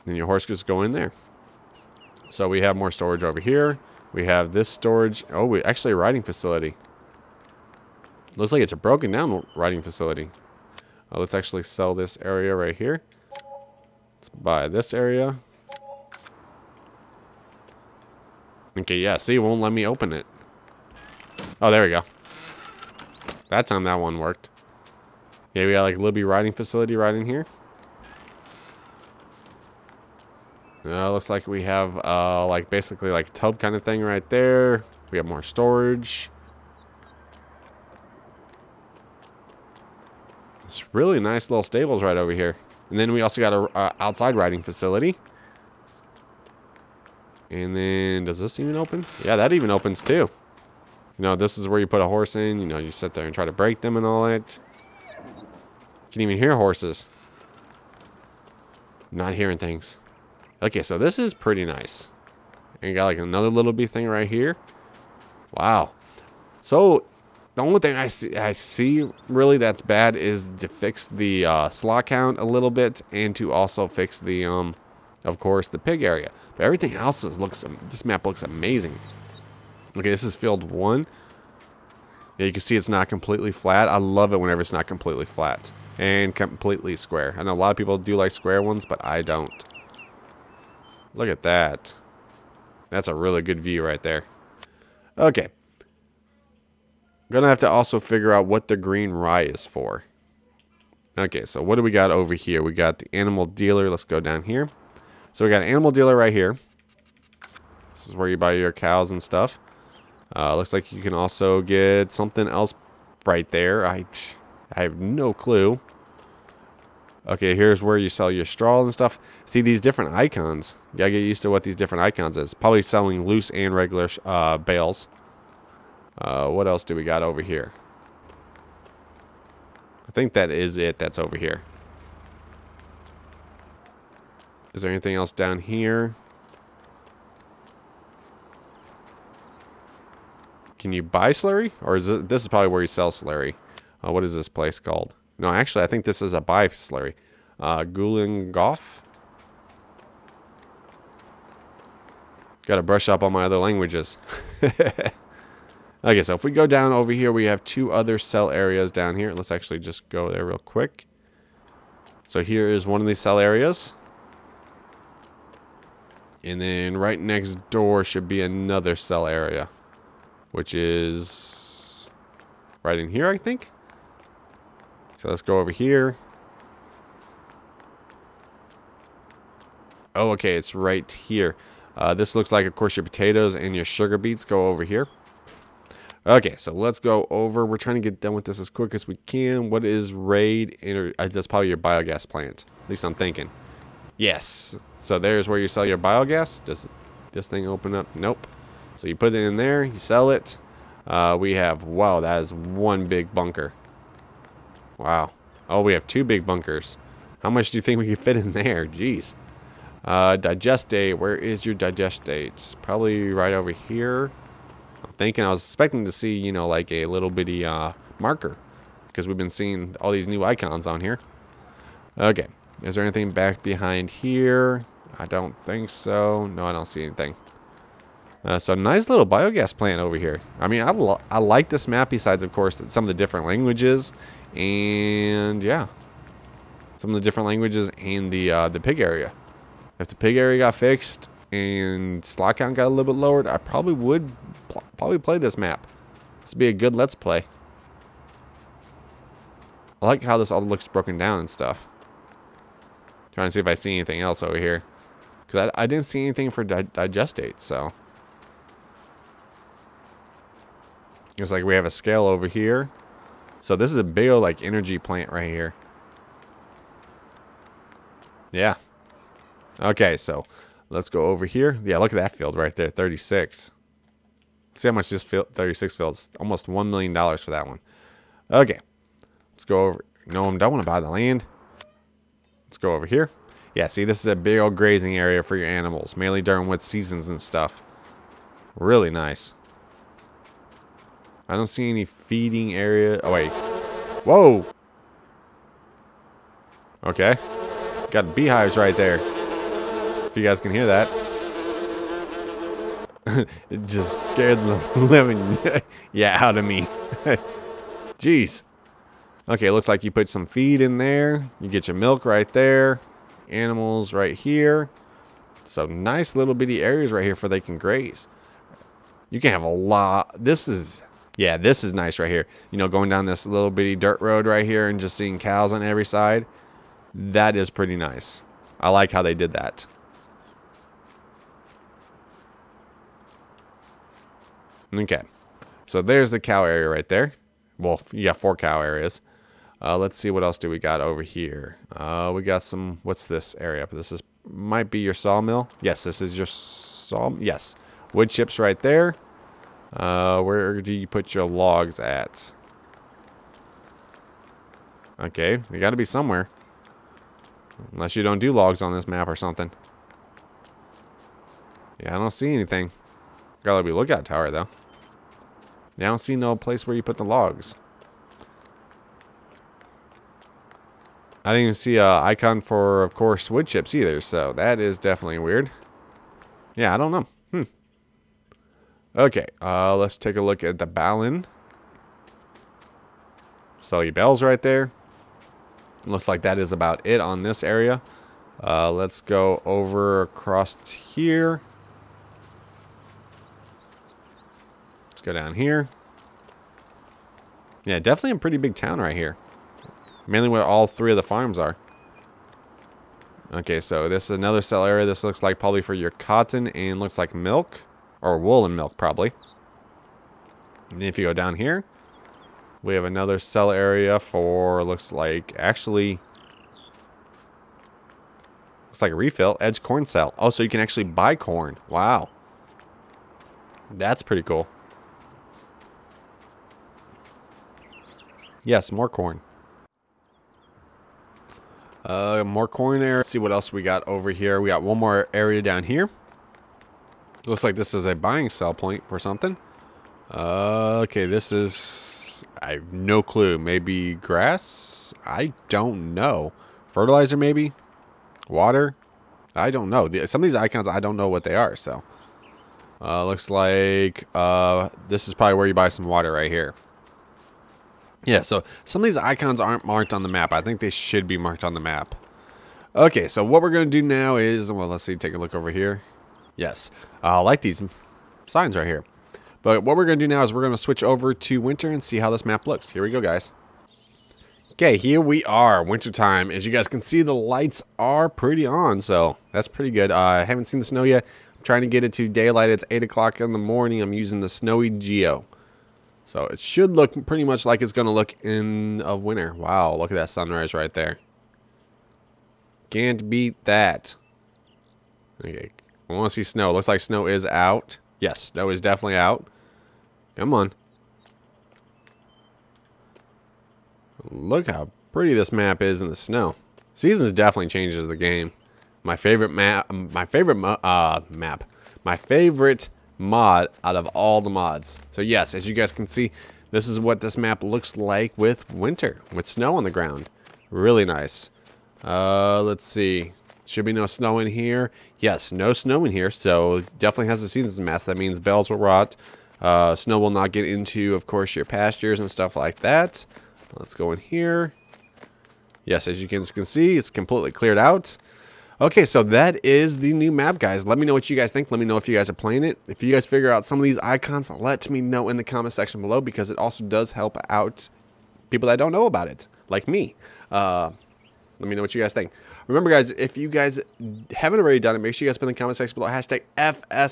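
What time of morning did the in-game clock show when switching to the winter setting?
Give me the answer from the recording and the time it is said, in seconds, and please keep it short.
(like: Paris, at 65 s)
8 o'clock, at 482 s.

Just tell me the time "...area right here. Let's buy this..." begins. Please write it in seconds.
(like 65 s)
12 s.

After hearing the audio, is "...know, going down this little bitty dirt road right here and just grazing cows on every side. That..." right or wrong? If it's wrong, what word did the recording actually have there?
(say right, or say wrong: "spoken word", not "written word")
wrong: "seeing", not "grazing".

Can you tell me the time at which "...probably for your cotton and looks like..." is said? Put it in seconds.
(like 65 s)
405 s.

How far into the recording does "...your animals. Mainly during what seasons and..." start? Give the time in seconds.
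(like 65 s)
285 s.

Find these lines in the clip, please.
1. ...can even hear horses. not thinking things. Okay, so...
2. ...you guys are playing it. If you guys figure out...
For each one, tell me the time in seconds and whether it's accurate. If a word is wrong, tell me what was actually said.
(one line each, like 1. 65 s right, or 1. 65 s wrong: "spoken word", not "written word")
1. 56 s wrong: "hearing", not "thinking"
2. 542 s right.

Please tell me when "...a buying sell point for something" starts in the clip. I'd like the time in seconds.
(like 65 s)
438 s.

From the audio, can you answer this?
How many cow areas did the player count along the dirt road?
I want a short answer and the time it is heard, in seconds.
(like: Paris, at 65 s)
4, at 338 s.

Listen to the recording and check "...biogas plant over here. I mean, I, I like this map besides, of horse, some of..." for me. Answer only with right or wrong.
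wrong.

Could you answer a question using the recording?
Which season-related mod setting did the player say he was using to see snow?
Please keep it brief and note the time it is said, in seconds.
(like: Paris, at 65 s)
Snowy Geo, at 484 s.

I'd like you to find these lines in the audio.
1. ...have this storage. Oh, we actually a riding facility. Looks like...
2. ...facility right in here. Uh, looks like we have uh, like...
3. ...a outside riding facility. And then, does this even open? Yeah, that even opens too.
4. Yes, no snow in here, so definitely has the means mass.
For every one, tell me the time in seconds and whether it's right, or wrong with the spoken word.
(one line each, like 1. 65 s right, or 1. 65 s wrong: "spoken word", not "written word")
1. 4 s right
2. 26 s right
3. 43 s right
4. 525 s wrong: "seasons", not "means".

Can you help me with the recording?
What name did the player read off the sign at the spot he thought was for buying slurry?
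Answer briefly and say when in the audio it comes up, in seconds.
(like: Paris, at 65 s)
Gulen Golf, at 147 s.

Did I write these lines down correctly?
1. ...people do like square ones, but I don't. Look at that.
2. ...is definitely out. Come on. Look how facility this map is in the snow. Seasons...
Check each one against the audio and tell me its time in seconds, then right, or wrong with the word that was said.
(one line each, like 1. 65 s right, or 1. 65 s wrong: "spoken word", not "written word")
1. 87 s right
2. 498 s wrong: "pretty", not "facility".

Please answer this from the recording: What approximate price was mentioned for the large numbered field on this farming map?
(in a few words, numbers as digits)
Almost $1 million.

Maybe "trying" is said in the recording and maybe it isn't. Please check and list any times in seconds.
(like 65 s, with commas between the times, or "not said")
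187 s, 253 s, 481 s.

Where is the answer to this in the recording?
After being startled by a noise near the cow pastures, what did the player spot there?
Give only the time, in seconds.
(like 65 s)
298 s.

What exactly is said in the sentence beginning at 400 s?
Mainly where all three of the farms are.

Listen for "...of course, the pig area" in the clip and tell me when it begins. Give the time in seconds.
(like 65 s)
75 s.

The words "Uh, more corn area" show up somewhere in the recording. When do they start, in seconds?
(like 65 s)
432 s.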